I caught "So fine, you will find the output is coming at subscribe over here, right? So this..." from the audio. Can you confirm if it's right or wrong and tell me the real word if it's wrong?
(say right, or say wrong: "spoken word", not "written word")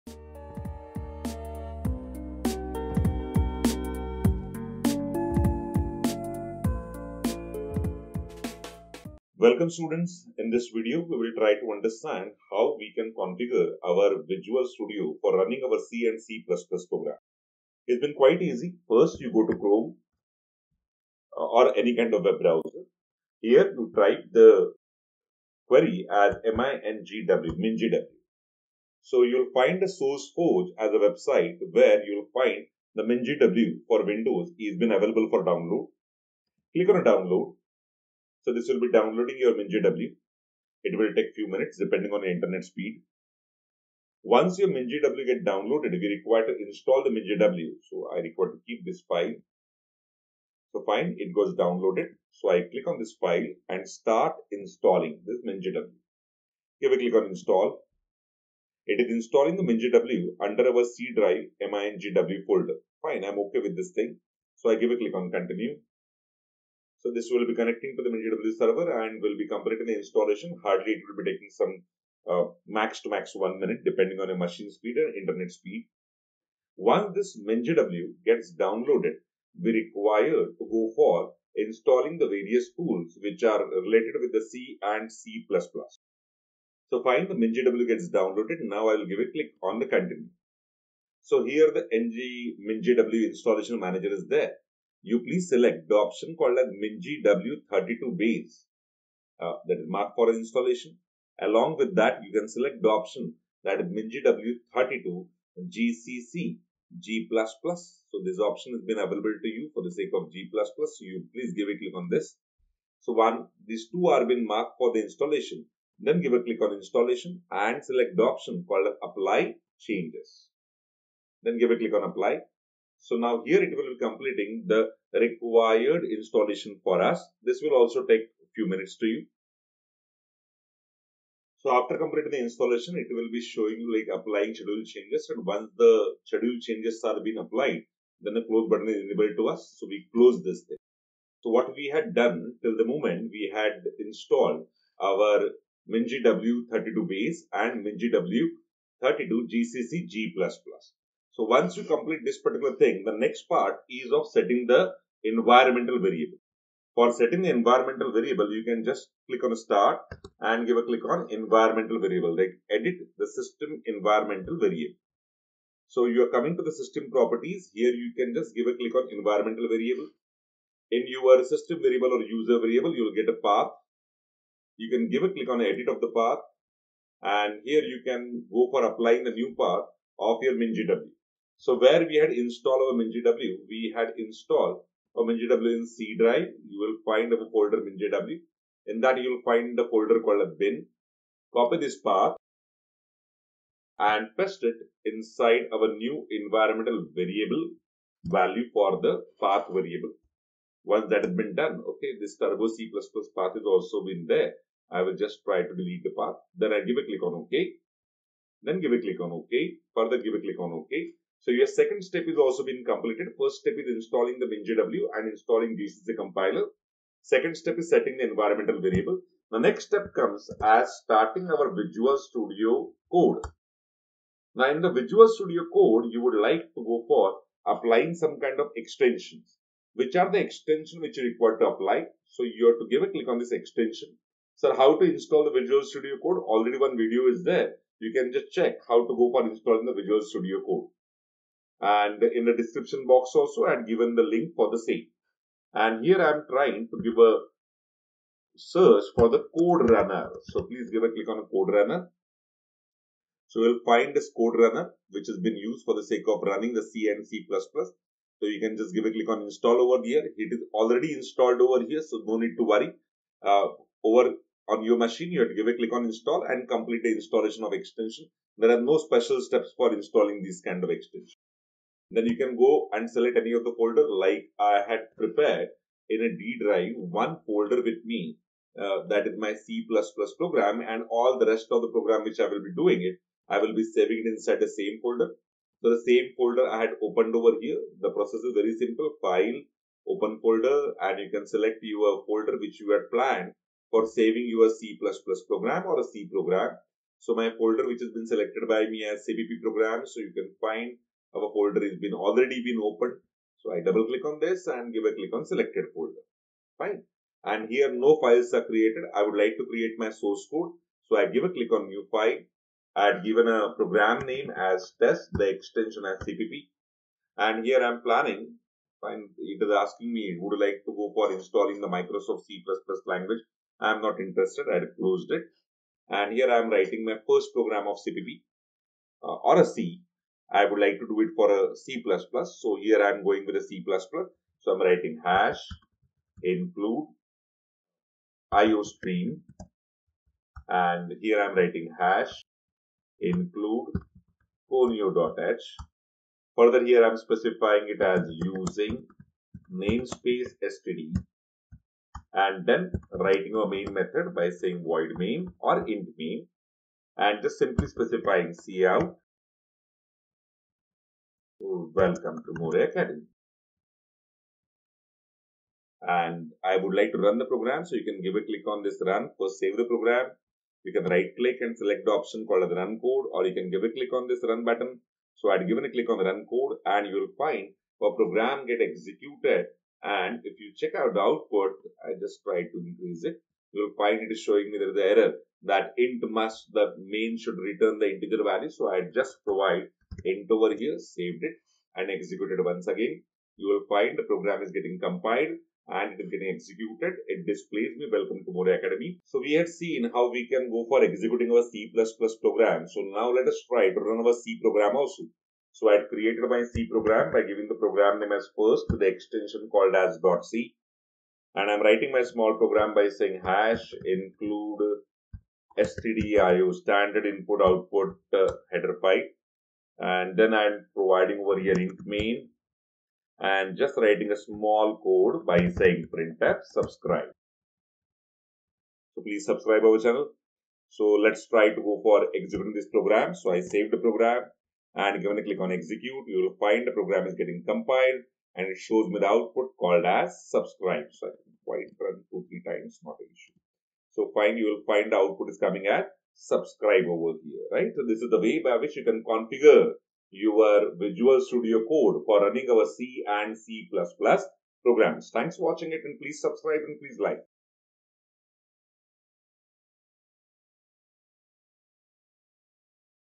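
right.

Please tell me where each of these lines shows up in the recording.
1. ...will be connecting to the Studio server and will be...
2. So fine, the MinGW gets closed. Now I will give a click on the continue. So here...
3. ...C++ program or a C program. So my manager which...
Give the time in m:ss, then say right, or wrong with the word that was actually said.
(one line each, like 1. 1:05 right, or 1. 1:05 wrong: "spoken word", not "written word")
1. 1:07 wrong: "MinGW", not "Studio"
2. 1:26 wrong: "downloaded", not "closed"
3. 4:54 wrong: "folder", not "manager".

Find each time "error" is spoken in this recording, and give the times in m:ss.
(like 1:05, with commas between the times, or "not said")
6:25.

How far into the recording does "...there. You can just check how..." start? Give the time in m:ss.
3:57.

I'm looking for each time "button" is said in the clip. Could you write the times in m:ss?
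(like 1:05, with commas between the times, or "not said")
2:18, 6:14.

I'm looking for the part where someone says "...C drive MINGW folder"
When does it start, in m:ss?
1:00.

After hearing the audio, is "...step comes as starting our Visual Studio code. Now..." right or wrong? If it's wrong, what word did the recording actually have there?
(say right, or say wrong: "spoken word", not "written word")
right.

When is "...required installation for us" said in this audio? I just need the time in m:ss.
2:05.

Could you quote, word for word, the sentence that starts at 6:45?
So I had created my C program by giving the program name as first with the extension called as .c.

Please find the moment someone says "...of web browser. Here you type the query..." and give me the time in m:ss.
0:22.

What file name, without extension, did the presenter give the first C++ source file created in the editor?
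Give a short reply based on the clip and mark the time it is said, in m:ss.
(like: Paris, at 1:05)
test, at 5:15.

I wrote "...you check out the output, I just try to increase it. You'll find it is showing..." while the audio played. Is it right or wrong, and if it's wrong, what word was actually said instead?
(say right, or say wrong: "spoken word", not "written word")
right.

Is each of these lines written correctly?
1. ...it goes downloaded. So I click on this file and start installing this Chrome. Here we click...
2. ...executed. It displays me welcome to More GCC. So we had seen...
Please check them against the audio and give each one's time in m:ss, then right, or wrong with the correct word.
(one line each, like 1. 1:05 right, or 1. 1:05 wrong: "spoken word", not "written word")
1. 0:51 wrong: "MinGW", not "Chrome"
2. 6:36 wrong: "Academy", not "GCC".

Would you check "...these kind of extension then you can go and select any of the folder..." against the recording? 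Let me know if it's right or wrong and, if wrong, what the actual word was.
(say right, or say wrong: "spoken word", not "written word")
right.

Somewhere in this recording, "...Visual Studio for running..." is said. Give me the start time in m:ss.
0:14.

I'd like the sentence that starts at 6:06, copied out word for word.
And I would like to run the program.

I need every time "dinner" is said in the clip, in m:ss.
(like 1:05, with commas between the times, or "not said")
not said.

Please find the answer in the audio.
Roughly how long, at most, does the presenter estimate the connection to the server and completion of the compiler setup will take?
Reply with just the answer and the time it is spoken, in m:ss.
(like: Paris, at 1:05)
one minute, at 1:13.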